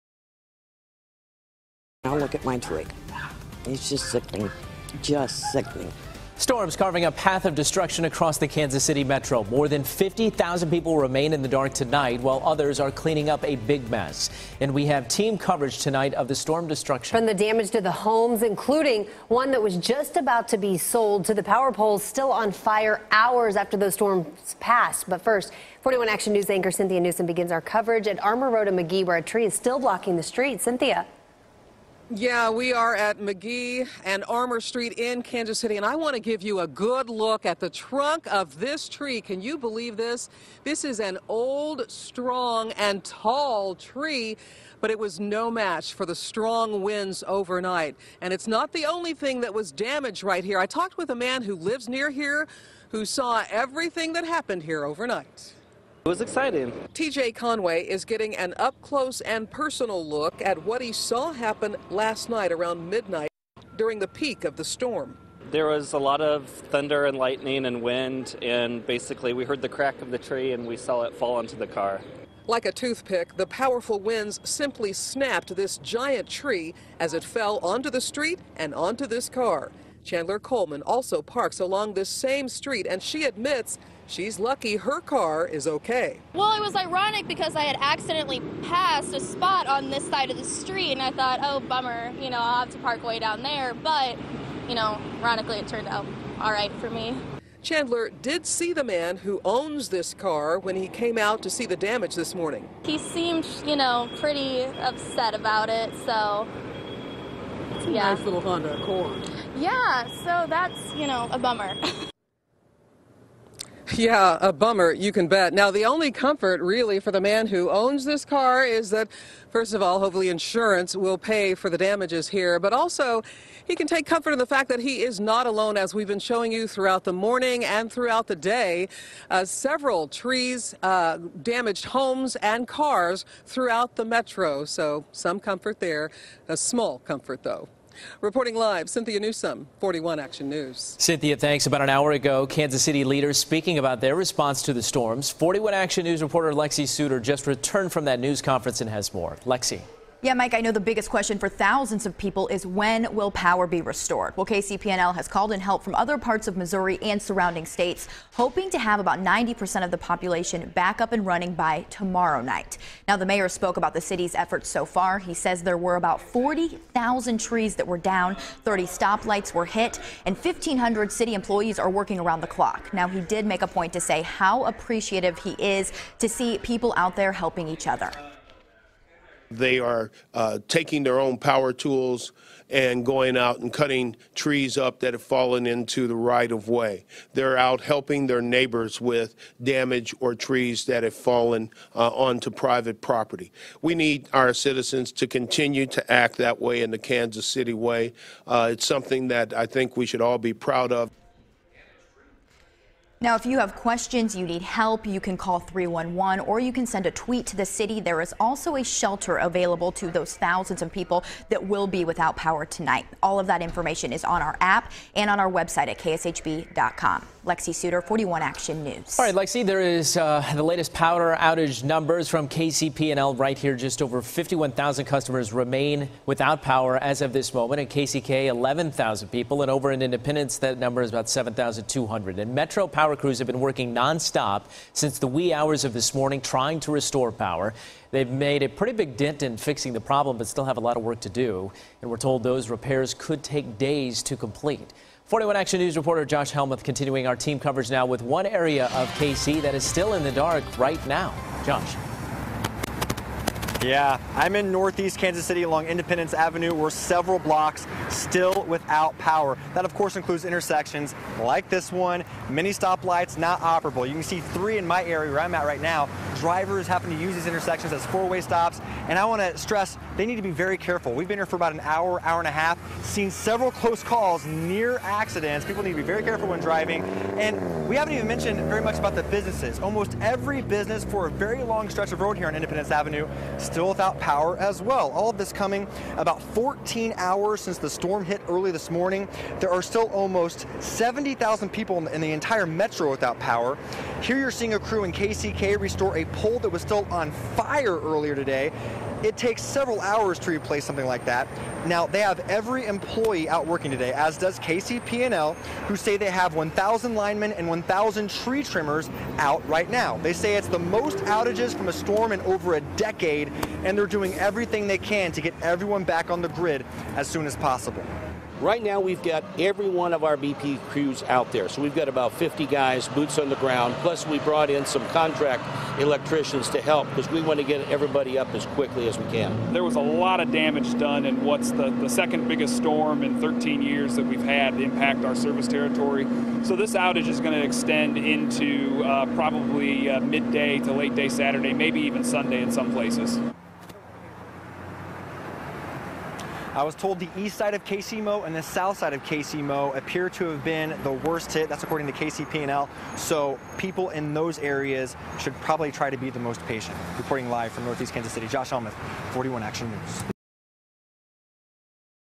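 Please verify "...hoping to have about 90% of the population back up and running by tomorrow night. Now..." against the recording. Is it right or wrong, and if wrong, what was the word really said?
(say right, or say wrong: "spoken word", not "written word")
right.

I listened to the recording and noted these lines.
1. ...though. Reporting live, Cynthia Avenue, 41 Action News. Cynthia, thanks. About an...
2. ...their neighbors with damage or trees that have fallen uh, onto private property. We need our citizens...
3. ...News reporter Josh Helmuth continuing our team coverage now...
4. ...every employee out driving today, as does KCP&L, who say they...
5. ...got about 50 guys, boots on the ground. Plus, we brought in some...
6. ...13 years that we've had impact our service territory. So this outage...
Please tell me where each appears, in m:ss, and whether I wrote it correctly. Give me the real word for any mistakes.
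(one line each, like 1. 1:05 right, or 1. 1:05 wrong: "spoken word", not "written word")
1. 2:17 wrong: "Newsome", not "Avenue"
2. 3:08 right
3. 4:05 right
4. 5:02 wrong: "working", not "driving"
5. 5:21 right
6. 5:33 right.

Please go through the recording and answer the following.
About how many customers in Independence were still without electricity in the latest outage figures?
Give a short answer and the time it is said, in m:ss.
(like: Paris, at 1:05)
7,200, at 3:51.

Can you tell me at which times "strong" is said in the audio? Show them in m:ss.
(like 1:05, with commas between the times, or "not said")
0:41, 0:46.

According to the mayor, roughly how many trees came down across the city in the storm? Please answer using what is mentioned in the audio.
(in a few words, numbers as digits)
40,000.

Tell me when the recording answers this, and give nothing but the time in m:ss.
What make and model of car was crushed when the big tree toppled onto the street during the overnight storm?
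1:48.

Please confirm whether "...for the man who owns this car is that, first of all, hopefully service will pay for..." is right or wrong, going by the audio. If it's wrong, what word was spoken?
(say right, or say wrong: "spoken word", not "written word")
wrong: "insurance", not "service".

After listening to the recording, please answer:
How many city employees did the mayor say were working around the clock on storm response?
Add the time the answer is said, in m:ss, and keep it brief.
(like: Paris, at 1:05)
1,500, at 2:50.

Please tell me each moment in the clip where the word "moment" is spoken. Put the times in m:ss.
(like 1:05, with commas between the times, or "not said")
3:47.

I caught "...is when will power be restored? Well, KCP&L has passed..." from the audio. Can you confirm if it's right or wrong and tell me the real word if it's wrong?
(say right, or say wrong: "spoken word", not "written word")
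wrong: "called", not "passed".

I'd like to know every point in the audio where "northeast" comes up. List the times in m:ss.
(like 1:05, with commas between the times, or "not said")
4:14, 5:57.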